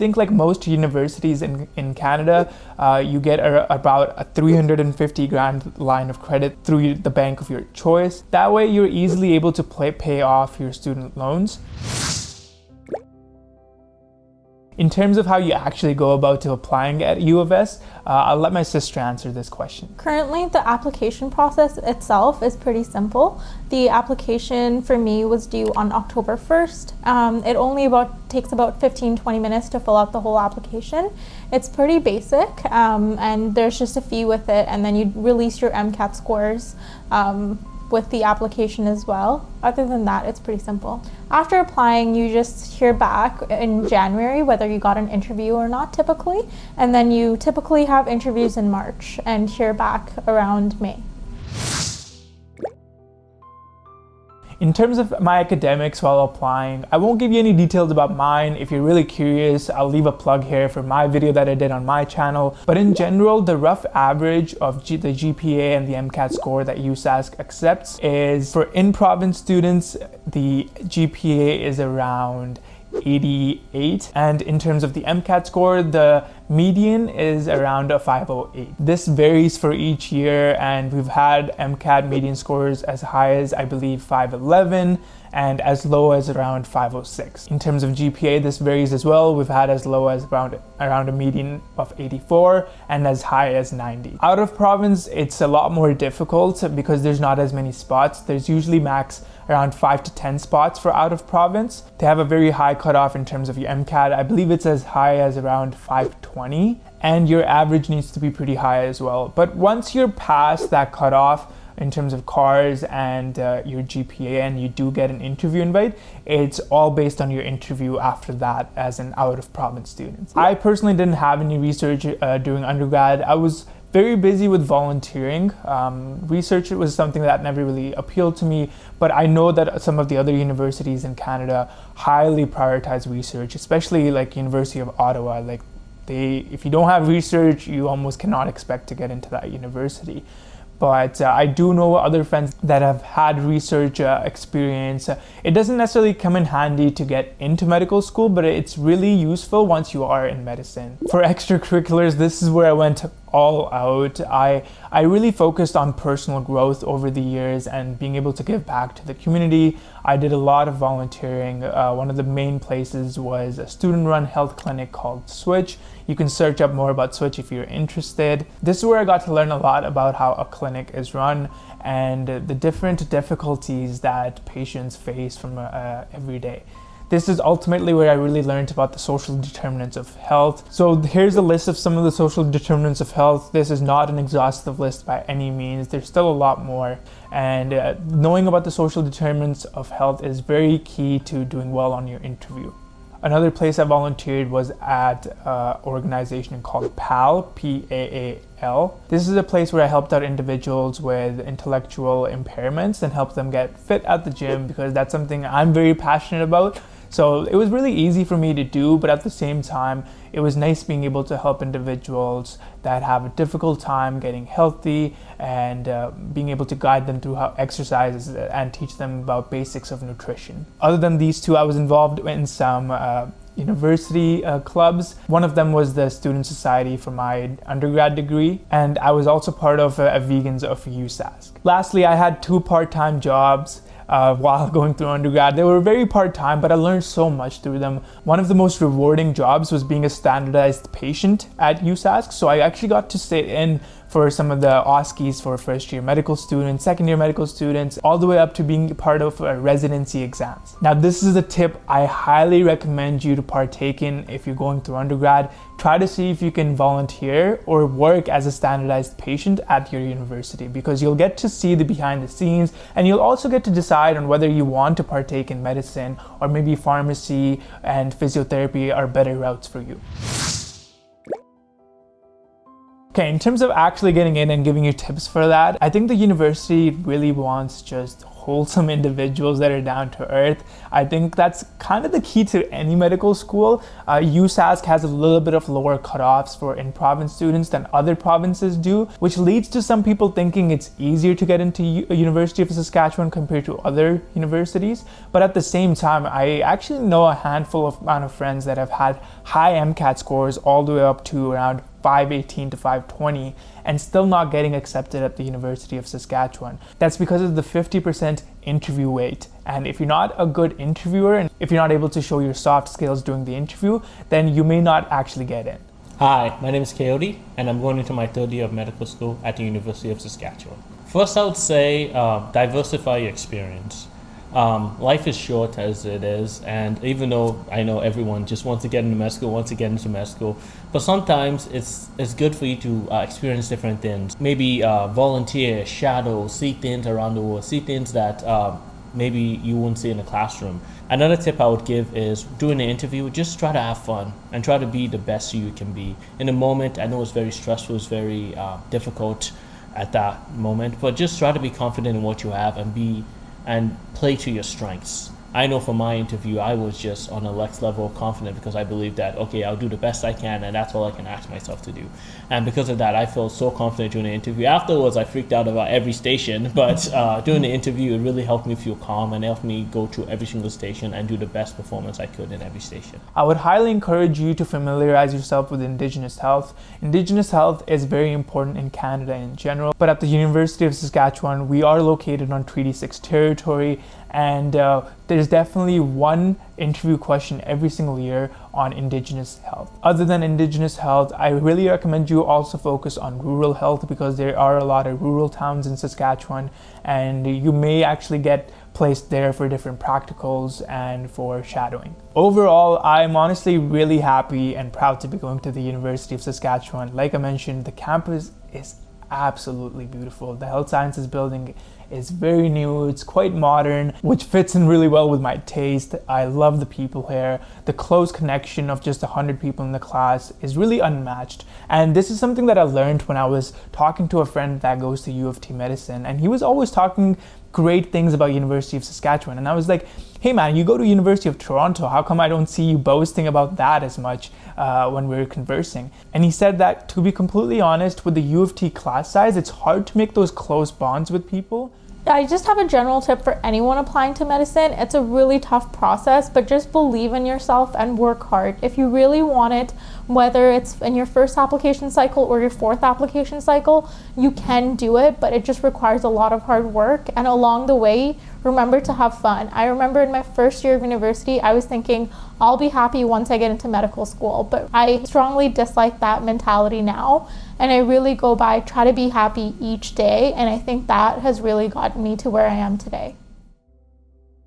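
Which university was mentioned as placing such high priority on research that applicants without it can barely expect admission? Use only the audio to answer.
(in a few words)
University of Ottawa.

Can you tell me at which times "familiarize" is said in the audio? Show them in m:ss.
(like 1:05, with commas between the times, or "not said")
6:14.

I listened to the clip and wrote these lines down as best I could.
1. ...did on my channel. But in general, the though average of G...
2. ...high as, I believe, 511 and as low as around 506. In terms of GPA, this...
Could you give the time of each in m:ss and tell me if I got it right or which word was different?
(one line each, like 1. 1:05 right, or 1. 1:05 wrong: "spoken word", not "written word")
1. 1:01 wrong: "rough", not "though"
2. 1:23 right.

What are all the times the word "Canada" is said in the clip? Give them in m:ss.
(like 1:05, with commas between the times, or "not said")
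0:01, 2:11, 6:18.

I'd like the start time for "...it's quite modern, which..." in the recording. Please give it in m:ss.
6:53.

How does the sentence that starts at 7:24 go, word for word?
It's a really tough process, but just believe in yourself and work hard.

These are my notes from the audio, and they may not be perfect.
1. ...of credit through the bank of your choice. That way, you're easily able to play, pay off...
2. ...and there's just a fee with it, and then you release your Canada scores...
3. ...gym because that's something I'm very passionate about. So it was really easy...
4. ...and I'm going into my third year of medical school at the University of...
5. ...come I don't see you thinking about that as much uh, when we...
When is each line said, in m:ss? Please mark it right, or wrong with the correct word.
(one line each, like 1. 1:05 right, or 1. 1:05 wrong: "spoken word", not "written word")
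1. 0:06 right
2. 0:33 wrong: "MCAT", not "Canada"
3. 3:24 right
4. 5:17 right
5. 7:12 wrong: "boasting", not "thinking".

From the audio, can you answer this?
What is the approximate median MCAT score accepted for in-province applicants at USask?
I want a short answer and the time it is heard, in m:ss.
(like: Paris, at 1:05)
508, at 1:17.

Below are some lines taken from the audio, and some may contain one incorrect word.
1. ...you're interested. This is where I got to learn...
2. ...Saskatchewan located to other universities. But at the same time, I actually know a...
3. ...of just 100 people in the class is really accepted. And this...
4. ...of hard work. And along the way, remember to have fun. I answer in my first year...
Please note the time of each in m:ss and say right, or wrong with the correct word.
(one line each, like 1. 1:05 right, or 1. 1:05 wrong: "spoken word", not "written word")
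1. 2:47 right
2. 4:52 wrong: "compared", not "located"
3. 6:58 wrong: "unmatched", not "accepted"
4. 7:36 wrong: "remember", not "answer".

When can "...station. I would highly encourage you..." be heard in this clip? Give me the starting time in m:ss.
6:12.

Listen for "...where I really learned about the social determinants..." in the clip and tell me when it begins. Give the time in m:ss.
2:57.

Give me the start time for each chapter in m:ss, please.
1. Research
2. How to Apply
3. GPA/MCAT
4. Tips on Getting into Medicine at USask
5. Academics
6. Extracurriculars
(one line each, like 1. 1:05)
1. 1:58
2. 0:10
3. 1:02
4. 4:28
5. 0:49
6. 2:29.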